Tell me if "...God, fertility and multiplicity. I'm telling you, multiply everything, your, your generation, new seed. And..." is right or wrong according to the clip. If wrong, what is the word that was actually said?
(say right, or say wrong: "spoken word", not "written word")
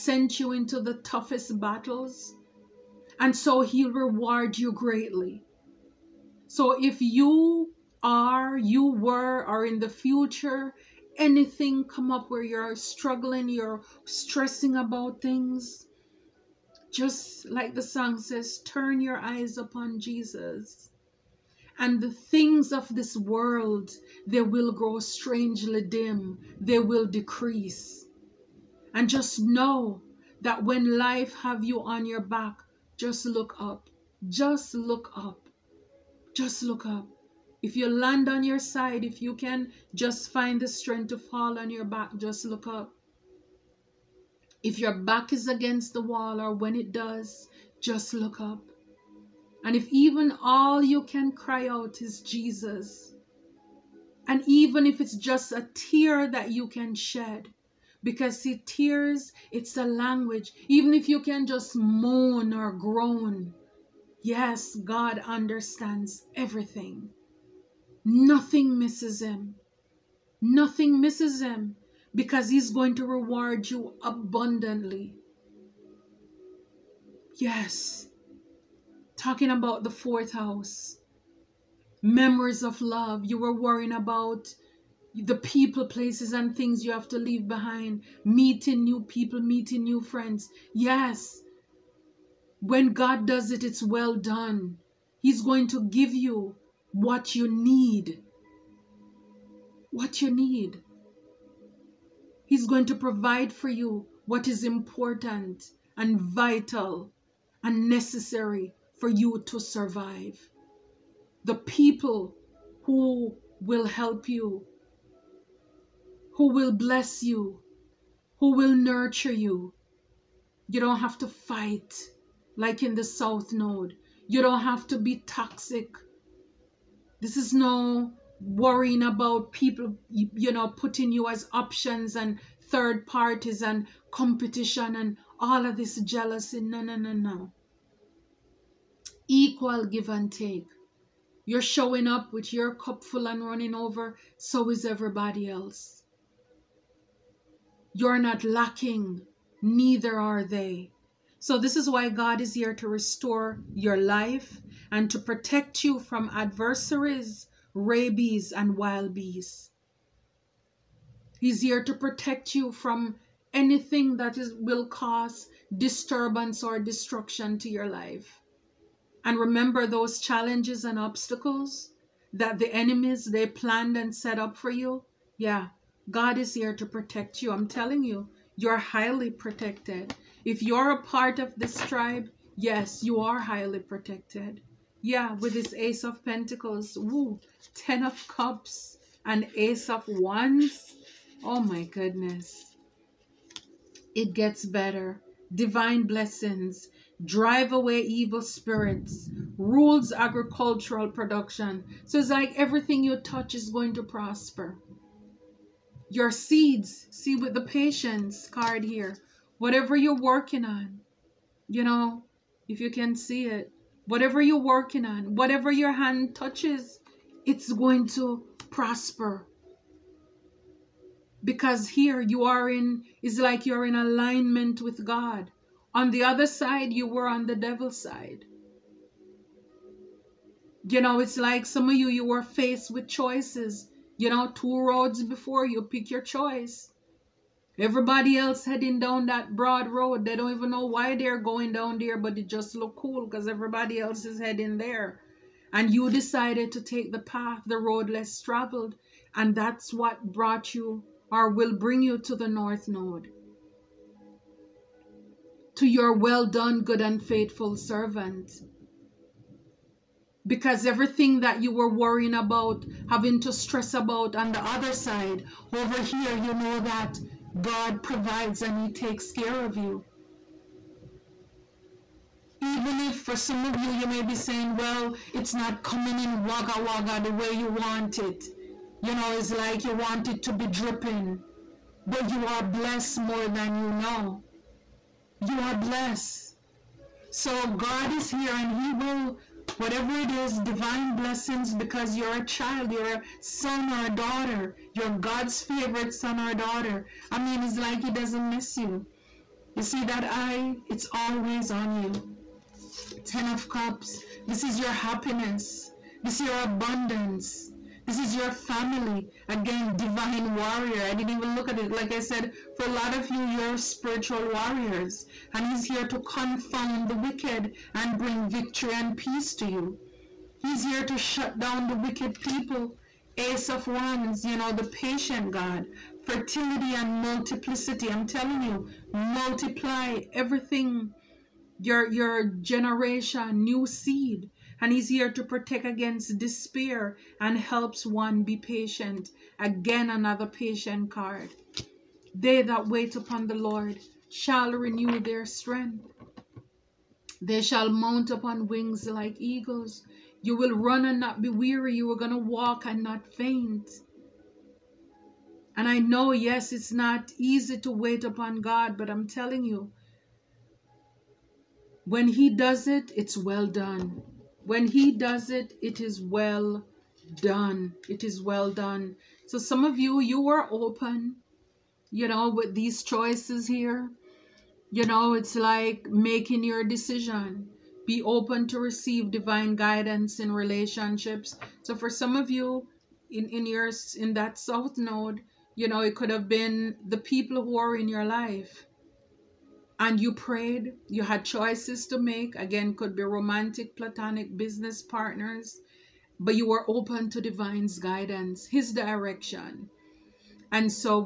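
right.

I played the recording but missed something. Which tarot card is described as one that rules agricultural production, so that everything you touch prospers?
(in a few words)
Ace of Pentacles.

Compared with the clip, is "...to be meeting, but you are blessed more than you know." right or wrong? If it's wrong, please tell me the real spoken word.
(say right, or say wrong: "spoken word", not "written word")
wrong: "dripping", not "meeting".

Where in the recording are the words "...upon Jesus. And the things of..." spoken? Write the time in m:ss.
0:19.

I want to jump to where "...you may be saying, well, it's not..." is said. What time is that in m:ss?
4:33.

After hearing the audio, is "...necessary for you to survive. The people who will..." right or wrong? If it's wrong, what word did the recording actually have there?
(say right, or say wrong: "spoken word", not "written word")
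right.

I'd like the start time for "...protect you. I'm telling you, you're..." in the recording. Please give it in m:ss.
2:56.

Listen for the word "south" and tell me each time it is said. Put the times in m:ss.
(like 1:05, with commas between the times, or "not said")
2:03, 6:24.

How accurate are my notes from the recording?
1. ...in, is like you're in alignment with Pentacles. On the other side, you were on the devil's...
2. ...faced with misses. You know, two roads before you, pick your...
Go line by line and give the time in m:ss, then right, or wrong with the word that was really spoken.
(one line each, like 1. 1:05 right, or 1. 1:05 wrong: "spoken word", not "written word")
1. 3:42 wrong: "God", not "Pentacles"
2. 3:52 wrong: "choices", not "misses".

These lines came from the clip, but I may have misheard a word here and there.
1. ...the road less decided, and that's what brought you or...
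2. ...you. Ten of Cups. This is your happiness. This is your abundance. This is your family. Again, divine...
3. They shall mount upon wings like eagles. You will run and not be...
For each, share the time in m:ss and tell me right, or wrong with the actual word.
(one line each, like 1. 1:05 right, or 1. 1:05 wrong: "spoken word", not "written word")
1. 4:07 wrong: "traveled", not "decided"
2. 5:01 right
3. 5:47 right.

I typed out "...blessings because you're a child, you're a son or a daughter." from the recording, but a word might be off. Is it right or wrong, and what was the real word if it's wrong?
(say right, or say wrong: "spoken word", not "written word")
right.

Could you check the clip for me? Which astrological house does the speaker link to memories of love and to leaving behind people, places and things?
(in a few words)
Fourth house.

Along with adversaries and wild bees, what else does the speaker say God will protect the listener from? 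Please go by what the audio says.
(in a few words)
Rabies.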